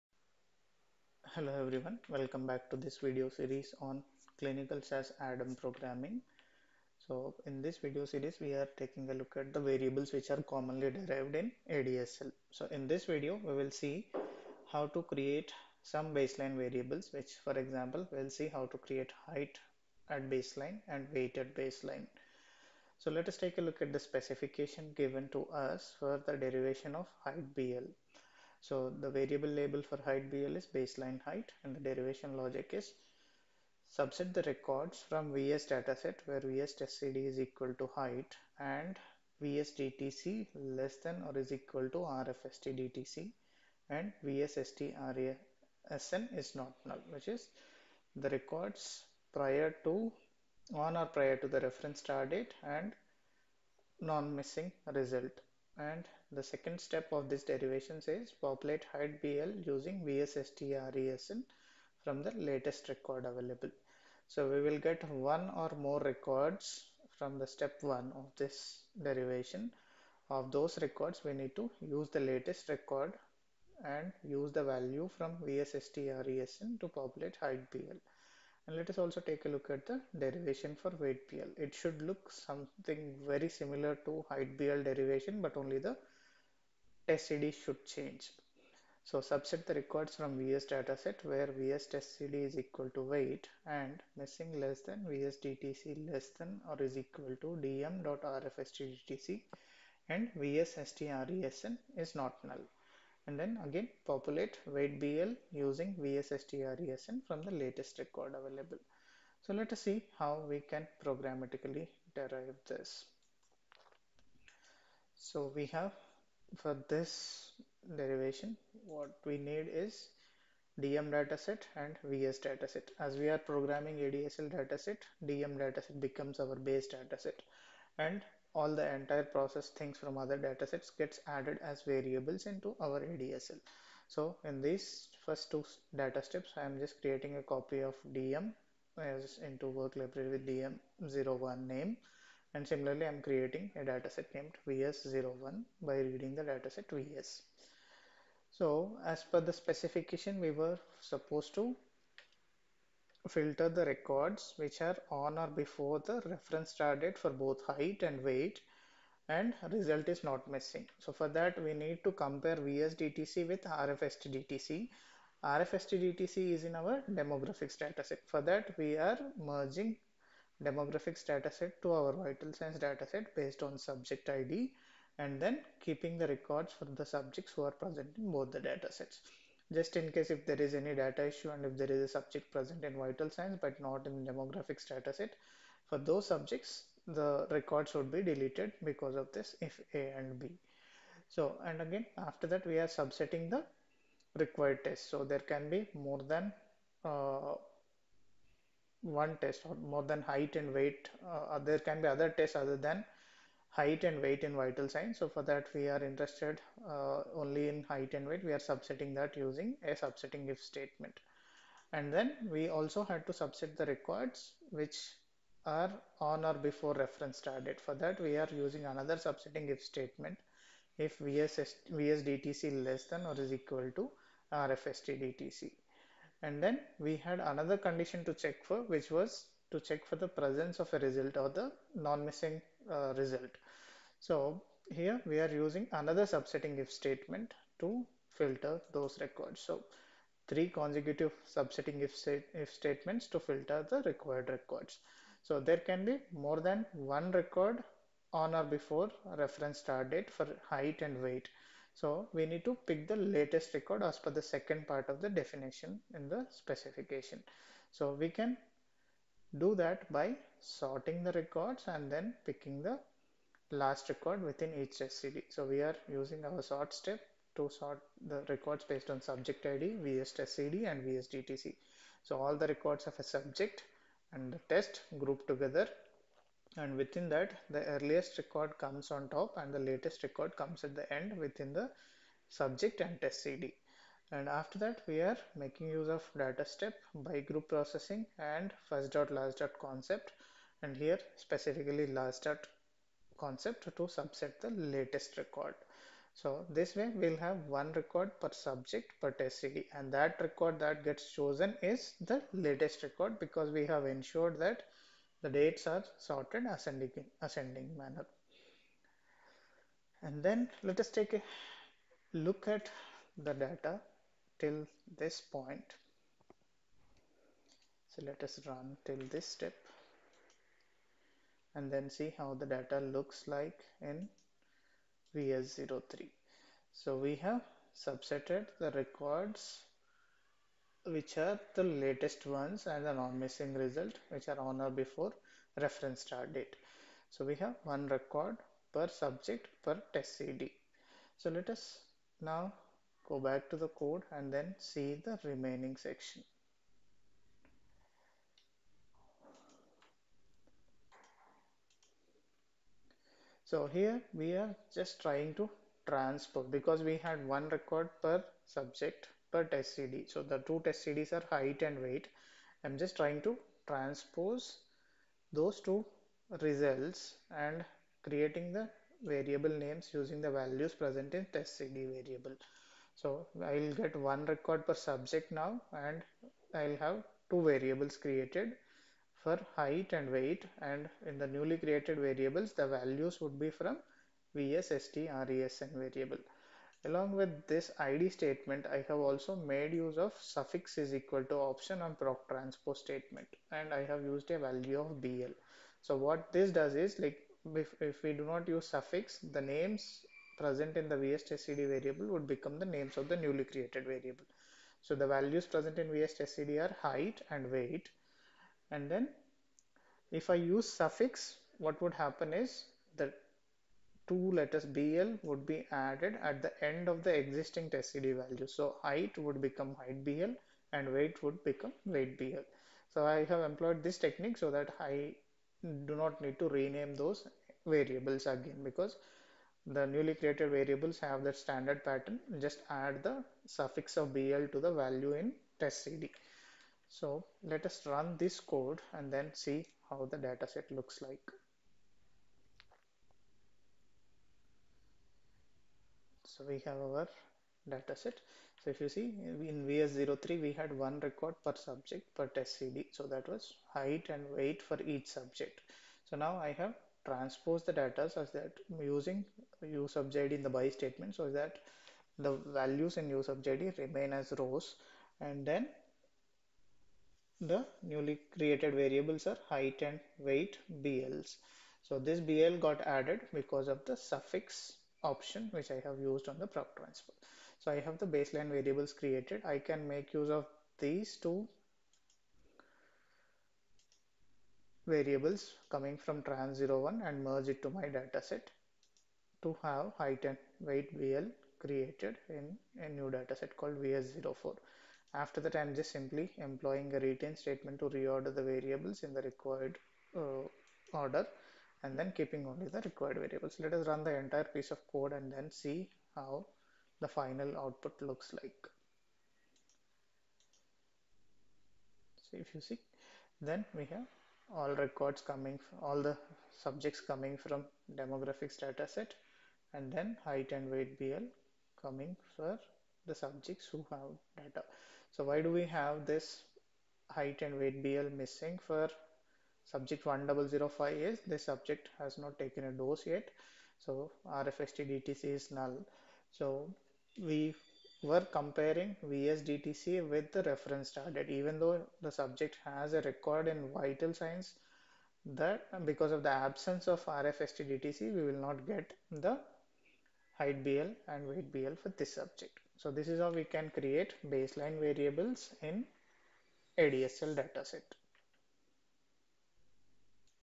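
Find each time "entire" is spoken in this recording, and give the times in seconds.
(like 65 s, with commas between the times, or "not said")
128 s, 504 s.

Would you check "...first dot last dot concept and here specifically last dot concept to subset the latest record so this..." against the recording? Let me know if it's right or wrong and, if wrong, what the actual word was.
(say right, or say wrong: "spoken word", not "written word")
right.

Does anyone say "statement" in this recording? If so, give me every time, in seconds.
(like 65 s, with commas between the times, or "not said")
210 s, 219 s, 236 s, 242 s, 388 s, 393 s, 460 s, 497 s.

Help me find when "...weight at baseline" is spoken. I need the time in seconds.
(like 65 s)
21 s.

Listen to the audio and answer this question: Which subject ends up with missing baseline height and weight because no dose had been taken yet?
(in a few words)
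1005.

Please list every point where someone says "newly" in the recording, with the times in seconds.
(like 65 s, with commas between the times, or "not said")
381 s, 403 s, 430 s, 468 s.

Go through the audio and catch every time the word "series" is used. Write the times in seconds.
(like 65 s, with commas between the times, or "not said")
3 s, 8 s.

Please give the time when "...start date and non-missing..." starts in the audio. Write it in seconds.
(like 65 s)
51 s.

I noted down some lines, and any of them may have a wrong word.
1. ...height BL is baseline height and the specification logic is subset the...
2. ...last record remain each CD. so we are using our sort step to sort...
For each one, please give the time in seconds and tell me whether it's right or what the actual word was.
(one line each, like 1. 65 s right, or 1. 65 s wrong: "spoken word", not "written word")
1. 29 s wrong: "derivation", not "specification"
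2. 263 s wrong: "within", not "remain".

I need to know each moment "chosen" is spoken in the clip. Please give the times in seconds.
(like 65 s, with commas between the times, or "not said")
301 s.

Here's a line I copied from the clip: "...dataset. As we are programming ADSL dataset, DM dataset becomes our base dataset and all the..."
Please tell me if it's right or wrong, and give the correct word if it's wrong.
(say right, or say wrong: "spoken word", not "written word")
right.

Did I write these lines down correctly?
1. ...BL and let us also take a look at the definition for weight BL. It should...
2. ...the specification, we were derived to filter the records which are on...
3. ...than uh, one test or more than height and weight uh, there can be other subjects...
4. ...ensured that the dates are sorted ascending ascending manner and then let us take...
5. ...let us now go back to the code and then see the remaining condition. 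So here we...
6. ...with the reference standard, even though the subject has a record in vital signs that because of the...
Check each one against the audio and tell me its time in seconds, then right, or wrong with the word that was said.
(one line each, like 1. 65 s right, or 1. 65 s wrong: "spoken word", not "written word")
1. 77 s wrong: "derivation", not "definition"
2. 149 s wrong: "supposed", not "derived"
3. 196 s wrong: "tests", not "subjects"
4. 304 s right
5. 341 s wrong: "section", not "condition"
6. 540 s right.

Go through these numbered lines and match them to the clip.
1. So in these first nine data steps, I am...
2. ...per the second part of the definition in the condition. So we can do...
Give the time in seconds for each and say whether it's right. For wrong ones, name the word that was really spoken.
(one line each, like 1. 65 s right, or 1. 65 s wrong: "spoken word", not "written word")
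1. 134 s wrong: "two", not "nine"
2. 254 s wrong: "specification", not "condition".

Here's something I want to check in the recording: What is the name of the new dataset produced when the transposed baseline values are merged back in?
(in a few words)
VS04.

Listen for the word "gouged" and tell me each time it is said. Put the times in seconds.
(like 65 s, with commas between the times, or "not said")
not said.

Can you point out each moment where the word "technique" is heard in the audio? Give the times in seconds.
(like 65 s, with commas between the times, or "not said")
424 s.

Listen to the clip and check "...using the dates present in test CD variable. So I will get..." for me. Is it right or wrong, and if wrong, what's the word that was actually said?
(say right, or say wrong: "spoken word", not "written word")
wrong: "values", not "dates".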